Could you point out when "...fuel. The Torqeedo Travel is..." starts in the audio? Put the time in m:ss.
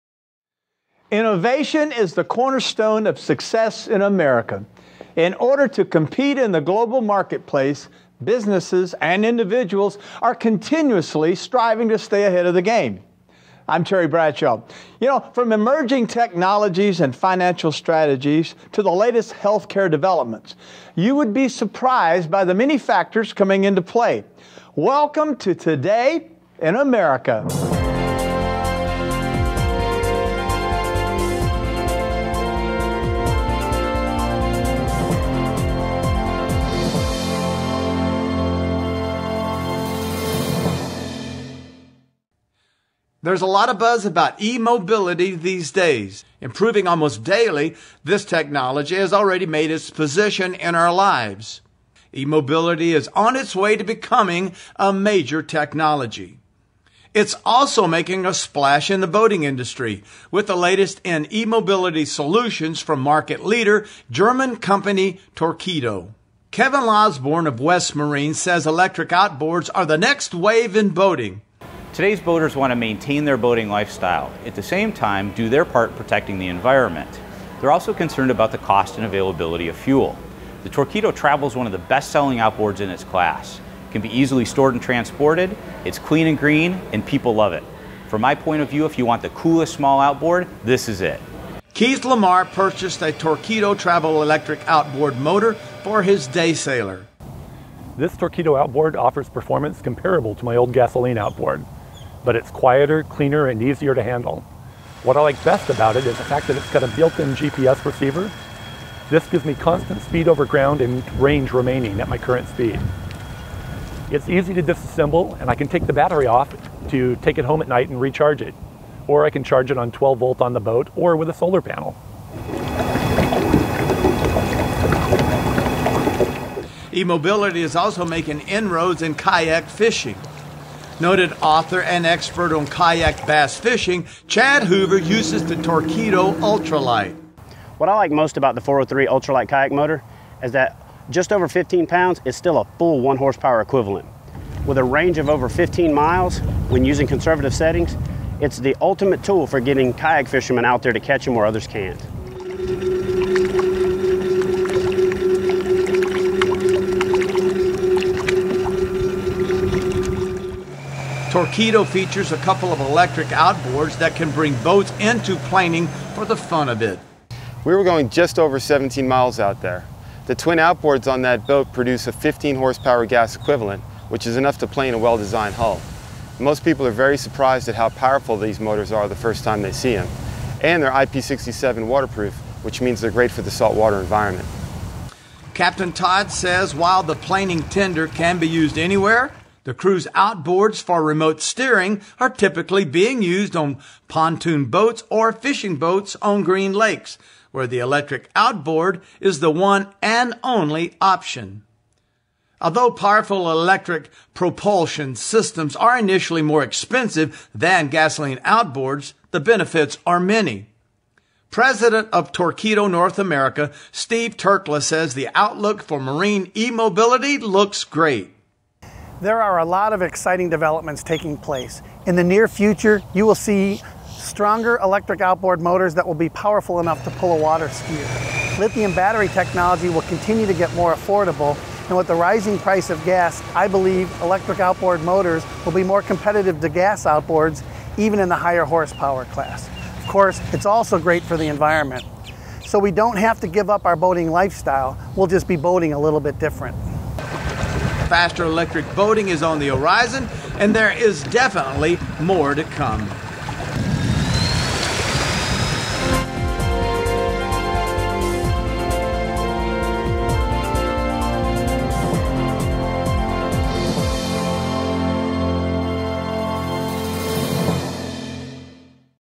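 1:19.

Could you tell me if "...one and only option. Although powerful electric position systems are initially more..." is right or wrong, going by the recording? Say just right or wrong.
wrong.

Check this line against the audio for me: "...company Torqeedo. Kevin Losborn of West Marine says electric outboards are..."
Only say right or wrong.
right.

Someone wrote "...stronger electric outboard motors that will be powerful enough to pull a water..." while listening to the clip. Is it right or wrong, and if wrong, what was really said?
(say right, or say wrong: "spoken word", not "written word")
right.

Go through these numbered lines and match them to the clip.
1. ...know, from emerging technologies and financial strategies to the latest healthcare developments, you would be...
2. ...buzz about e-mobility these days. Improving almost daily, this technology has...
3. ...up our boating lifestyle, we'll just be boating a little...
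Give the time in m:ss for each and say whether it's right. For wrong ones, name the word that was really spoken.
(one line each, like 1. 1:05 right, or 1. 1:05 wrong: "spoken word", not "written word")
1. 0:15 right
2. 0:43 right
3. 4:03 right.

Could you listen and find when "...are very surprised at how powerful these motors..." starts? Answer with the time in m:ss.
2:56.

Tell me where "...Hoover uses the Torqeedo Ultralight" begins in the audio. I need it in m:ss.
2:14.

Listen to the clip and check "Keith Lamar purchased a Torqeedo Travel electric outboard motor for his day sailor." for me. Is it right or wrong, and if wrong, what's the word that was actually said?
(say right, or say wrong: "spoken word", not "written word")
right.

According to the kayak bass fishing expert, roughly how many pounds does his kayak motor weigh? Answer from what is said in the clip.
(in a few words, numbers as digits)
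15 pounds.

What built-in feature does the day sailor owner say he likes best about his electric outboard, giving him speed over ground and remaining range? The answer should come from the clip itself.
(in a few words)
GPS receiver.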